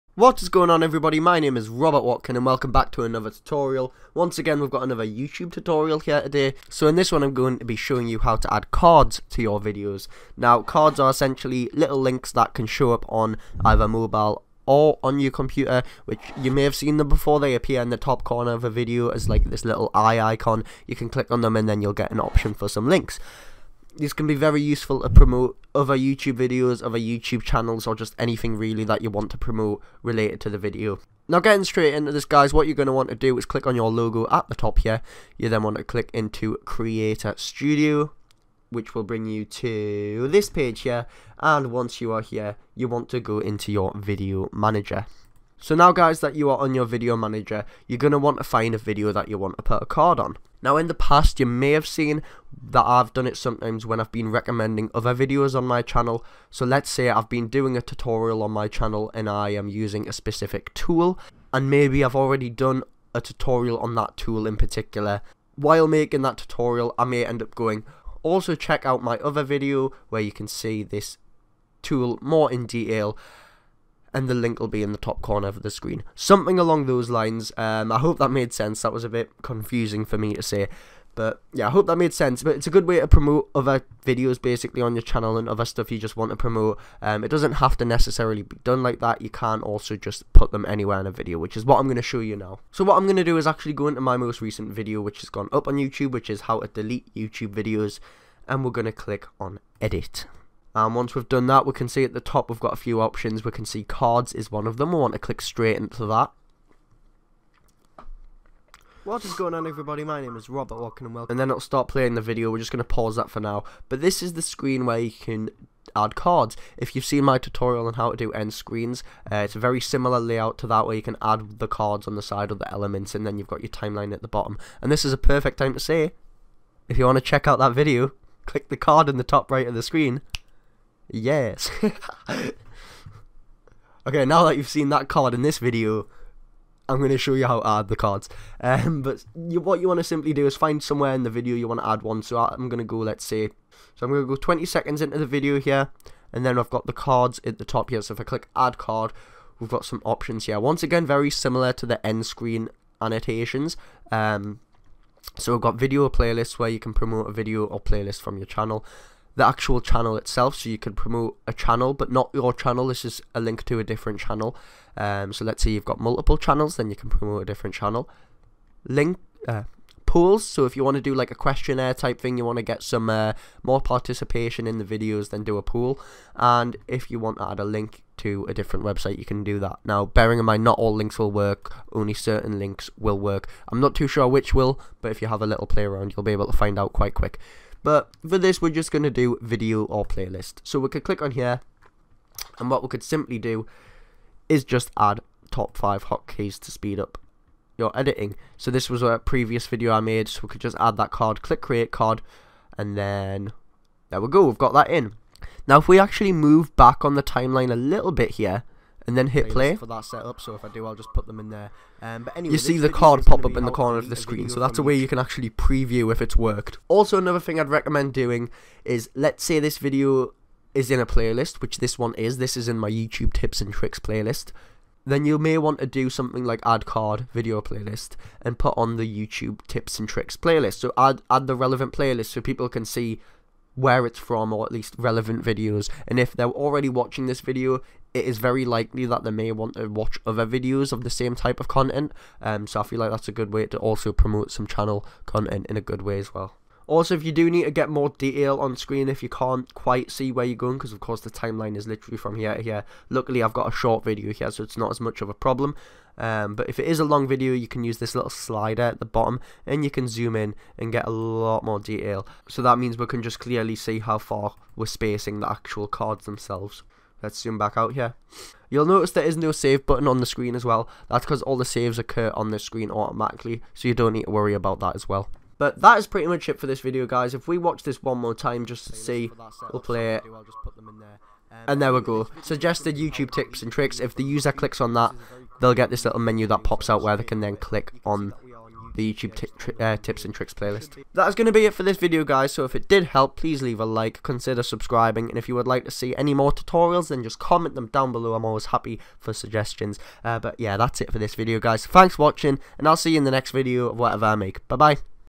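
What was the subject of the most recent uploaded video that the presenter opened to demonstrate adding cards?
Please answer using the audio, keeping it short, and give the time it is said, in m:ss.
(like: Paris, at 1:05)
How to delete YouTube videos, at 1:36.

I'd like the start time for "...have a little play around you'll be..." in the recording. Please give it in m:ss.
3:05.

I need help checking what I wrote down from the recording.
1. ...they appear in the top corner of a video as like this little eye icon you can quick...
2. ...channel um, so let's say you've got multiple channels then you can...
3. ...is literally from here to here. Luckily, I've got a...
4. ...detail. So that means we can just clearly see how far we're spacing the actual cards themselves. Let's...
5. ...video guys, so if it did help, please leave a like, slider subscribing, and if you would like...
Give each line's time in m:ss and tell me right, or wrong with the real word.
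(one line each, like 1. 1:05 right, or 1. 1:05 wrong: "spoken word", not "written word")
1. 0:17 wrong: "click", not "quick"
2. 2:44 right
3. 4:11 right
4. 4:21 right
5. 4:51 wrong: "consider", not "slider".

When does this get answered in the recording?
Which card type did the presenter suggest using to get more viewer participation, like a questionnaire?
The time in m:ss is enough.
2:50.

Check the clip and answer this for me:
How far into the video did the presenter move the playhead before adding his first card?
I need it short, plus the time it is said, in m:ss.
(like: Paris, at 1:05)
20 seconds, at 2:24.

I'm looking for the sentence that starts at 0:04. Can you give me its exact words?
Once again we've got another YouTube tutorial here today.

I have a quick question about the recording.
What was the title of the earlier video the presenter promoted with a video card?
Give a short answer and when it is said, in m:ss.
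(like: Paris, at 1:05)
Top 5 hotkeys to speed up your editing, at 3:15.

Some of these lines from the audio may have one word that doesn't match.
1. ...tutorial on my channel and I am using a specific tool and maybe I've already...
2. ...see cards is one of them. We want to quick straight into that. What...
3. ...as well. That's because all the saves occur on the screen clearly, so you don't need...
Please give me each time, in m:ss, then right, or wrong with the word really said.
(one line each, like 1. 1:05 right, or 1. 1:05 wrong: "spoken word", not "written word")
1. 0:57 right
2. 1:43 wrong: "click", not "quick"
3. 4:30 wrong: "automatically", not "clearly".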